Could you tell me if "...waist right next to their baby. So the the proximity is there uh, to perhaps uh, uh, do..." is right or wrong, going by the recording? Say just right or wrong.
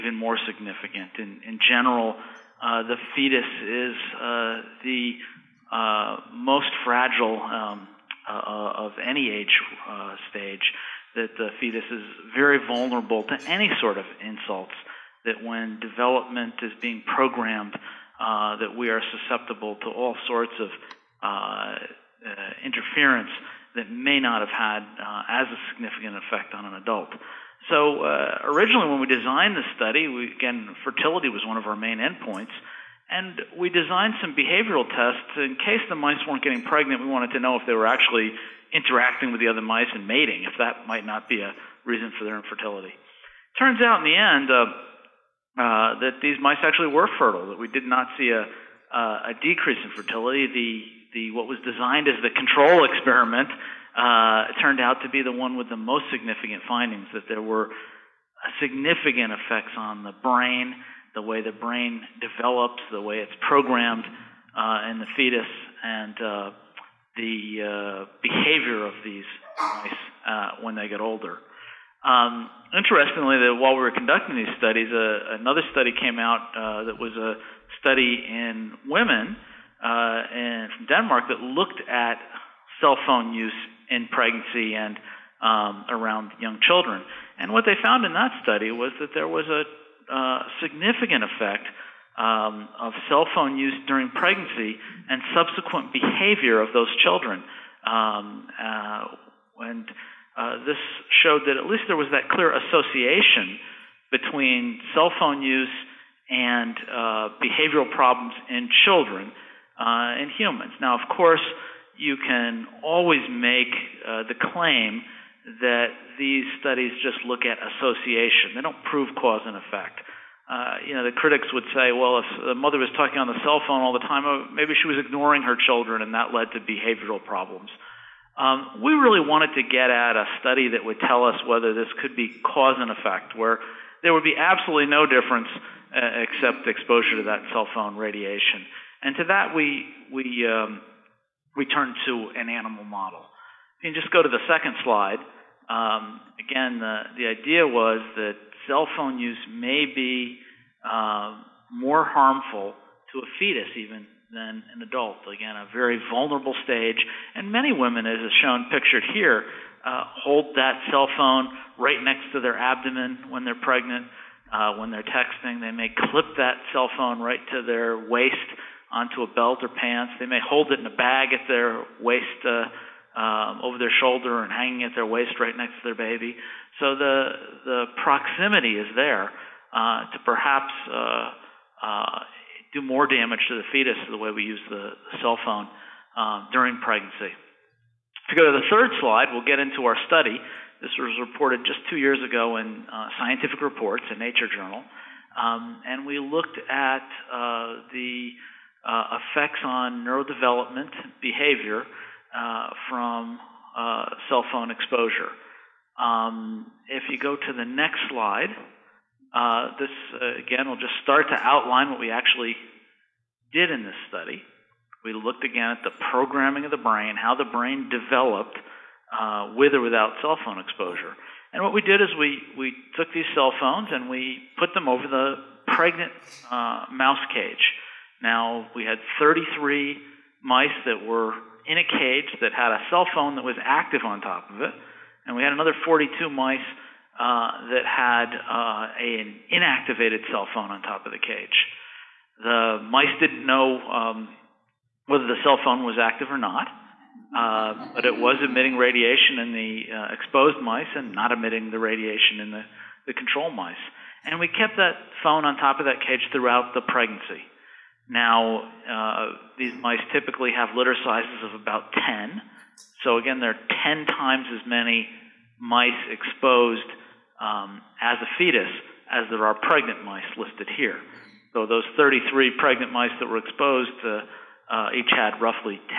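right.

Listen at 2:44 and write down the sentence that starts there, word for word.
Uh, when they're texting, they may clip that cell phone right to their waist onto a belt or pants.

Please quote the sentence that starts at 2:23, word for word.
You can just go to the second slide.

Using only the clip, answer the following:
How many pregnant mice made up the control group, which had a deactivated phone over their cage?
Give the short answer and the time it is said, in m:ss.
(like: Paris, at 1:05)
42, at 3:55.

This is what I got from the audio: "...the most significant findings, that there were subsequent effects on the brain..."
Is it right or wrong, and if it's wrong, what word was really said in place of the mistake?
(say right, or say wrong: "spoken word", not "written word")
wrong: "significant", not "subsequent".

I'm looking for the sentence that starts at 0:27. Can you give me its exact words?
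So originally, when we designed the study, we, again, fertility was one of our main endpoints.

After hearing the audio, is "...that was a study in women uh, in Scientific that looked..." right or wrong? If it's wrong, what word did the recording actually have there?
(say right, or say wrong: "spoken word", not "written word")
wrong: "Denmark", not "Scientific".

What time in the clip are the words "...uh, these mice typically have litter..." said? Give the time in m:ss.
4:18.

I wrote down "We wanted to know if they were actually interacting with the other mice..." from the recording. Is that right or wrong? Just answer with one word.
right.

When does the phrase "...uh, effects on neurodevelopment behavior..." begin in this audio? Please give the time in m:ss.
3:18.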